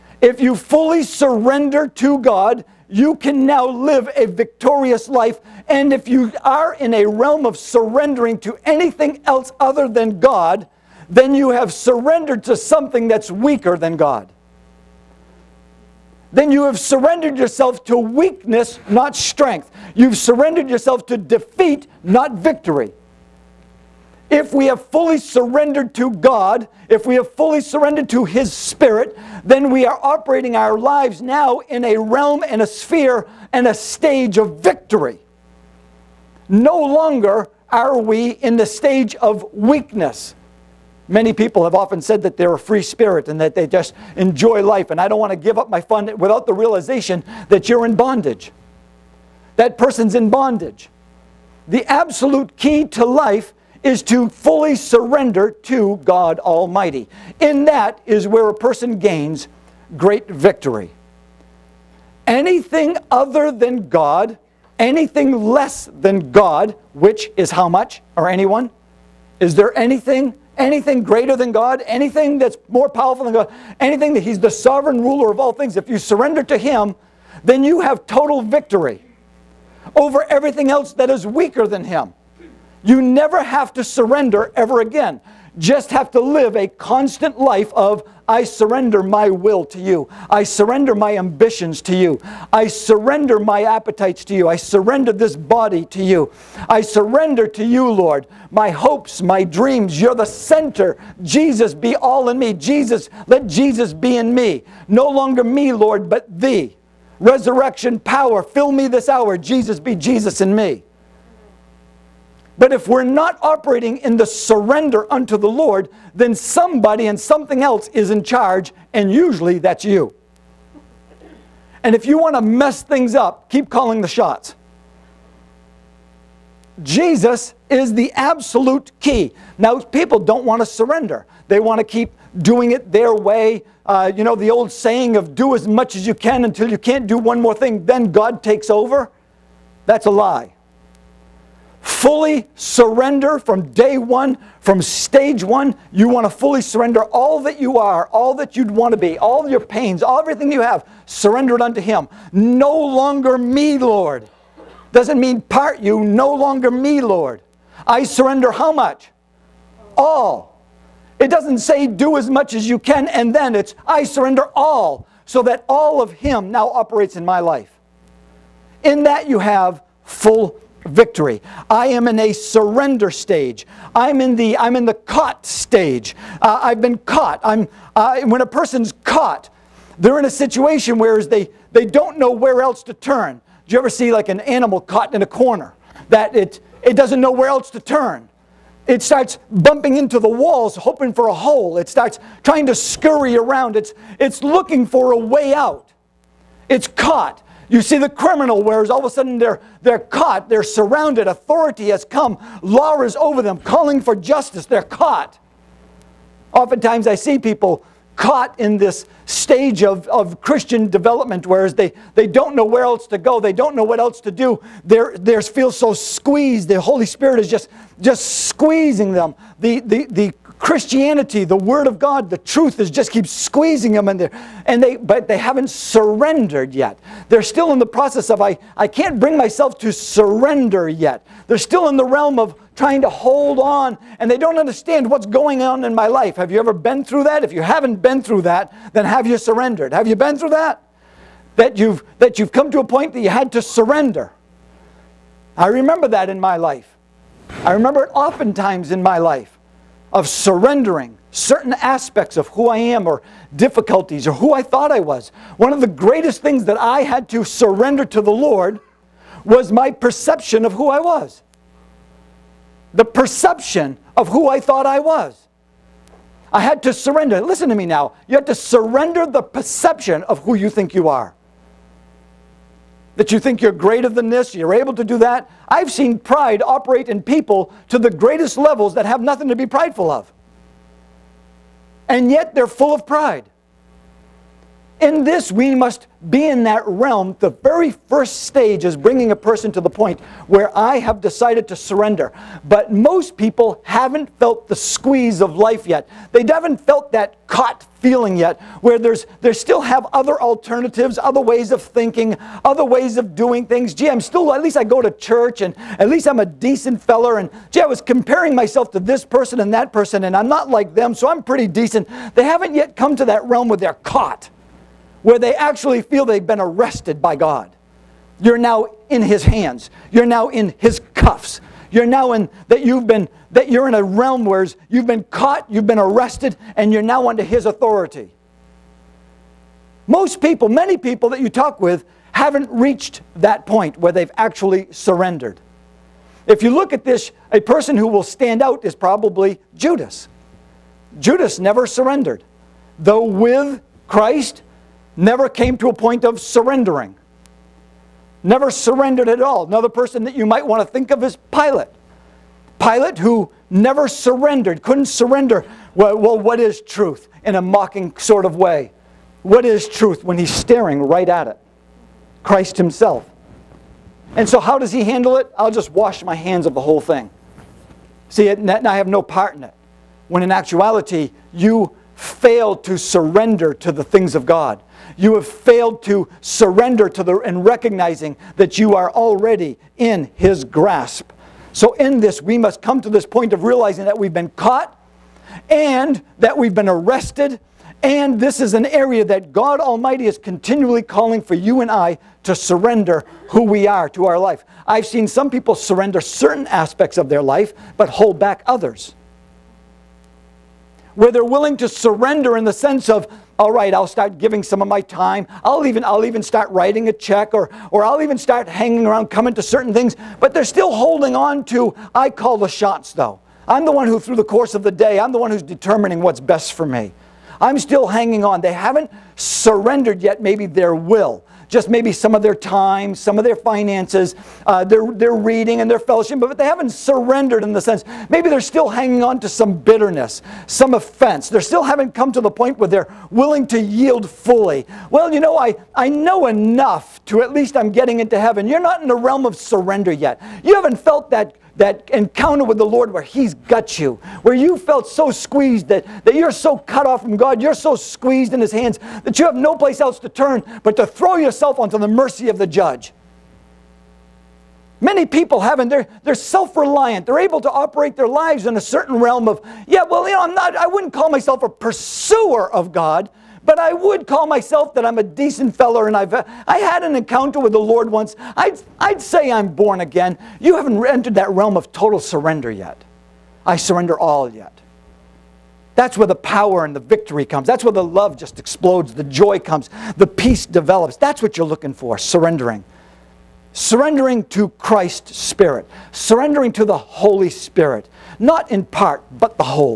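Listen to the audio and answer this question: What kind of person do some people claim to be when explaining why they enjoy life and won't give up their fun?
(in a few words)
a free spirit.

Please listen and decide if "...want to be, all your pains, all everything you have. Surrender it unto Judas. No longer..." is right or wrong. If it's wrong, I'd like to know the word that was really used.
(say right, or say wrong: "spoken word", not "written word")
wrong: "Him", not "Judas".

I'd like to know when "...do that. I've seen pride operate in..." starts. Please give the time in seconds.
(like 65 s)
275 s.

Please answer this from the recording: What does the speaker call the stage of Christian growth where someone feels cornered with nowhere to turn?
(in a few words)
the caught stage.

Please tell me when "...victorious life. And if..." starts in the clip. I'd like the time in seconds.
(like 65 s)
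4 s.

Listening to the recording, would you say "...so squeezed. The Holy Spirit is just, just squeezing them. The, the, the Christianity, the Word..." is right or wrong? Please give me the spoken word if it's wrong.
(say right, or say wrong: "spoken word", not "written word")
right.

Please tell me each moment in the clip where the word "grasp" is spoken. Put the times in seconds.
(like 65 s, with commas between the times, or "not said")
380 s.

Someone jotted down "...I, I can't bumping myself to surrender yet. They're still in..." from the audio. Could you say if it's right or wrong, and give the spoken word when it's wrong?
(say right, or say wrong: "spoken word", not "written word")
wrong: "bring", not "bumping".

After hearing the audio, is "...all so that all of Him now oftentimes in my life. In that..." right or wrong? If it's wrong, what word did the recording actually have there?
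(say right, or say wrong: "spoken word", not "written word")
wrong: "operates", not "oftentimes".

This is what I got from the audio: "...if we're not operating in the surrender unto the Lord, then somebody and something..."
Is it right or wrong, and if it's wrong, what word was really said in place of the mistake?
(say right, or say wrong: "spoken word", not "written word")
right.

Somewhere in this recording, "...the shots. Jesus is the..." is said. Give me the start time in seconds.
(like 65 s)
124 s.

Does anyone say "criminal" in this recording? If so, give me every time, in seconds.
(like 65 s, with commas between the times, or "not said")
198 s.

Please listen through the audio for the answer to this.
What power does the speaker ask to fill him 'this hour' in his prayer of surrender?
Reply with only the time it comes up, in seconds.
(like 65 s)
107 s.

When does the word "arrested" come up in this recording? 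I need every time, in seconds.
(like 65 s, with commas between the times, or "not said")
316 s, 325 s, 386 s.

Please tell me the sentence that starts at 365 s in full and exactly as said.
I'll just wash my hands of the whole thing.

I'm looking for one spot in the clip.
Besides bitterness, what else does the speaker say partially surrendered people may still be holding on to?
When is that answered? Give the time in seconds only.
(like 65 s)
430 s.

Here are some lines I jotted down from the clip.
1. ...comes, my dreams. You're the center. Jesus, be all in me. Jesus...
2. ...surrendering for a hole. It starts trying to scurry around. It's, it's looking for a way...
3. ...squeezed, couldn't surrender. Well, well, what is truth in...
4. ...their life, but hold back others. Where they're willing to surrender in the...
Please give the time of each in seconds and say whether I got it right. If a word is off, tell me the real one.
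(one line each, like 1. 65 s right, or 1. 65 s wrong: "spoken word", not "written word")
1. 98 s wrong: "hopes", not "comes"
2. 190 s wrong: "hoping", not "surrendering"
3. 354 s wrong: "surrendered", not "squeezed"
4. 397 s right.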